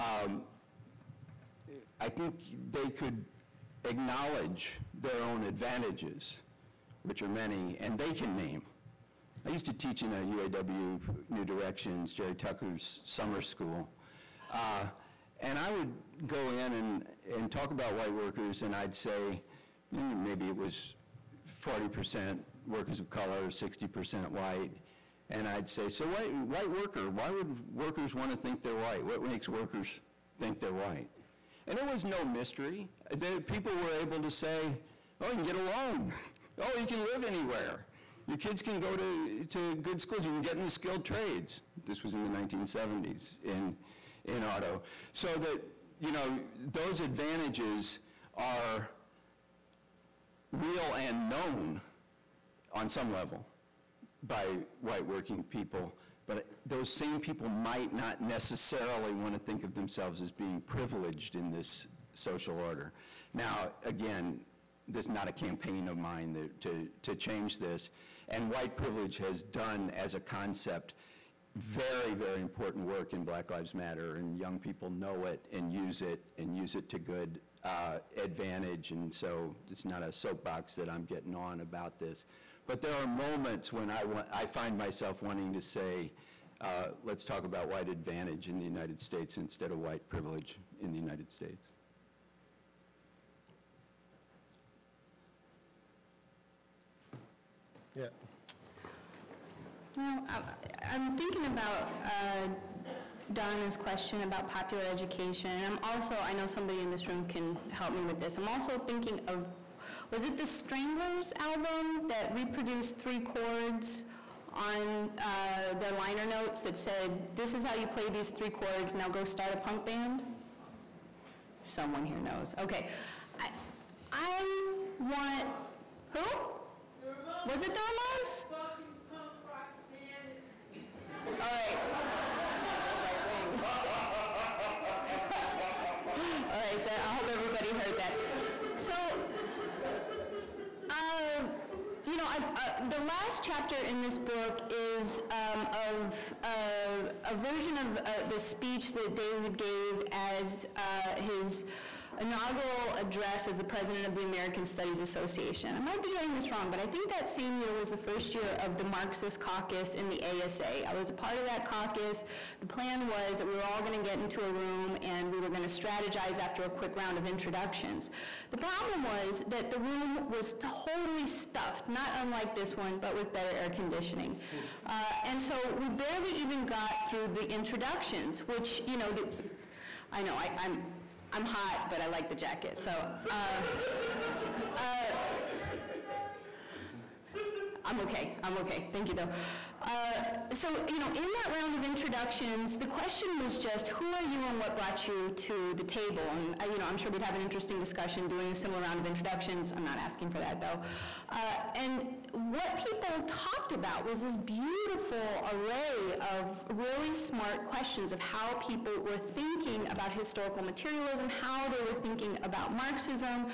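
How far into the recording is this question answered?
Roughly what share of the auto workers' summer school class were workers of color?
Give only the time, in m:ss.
0:21.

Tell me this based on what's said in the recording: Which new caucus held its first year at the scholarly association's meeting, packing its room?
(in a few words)
Marxist caucus.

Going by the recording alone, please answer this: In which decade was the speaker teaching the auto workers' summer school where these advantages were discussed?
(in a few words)
1970s.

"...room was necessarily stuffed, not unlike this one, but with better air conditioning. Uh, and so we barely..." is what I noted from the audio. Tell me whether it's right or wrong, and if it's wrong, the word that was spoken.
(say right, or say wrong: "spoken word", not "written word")
wrong: "totally", not "necessarily".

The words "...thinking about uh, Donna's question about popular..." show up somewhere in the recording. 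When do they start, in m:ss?
1:41.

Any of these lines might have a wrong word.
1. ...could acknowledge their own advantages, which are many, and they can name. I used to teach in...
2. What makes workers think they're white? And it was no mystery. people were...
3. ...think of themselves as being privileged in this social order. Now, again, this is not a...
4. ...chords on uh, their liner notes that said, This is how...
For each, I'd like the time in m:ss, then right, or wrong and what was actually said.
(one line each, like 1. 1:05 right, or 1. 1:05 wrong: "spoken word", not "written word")
1. 0:02 right
2. 0:29 right
3. 0:59 right
4. 1:53 right.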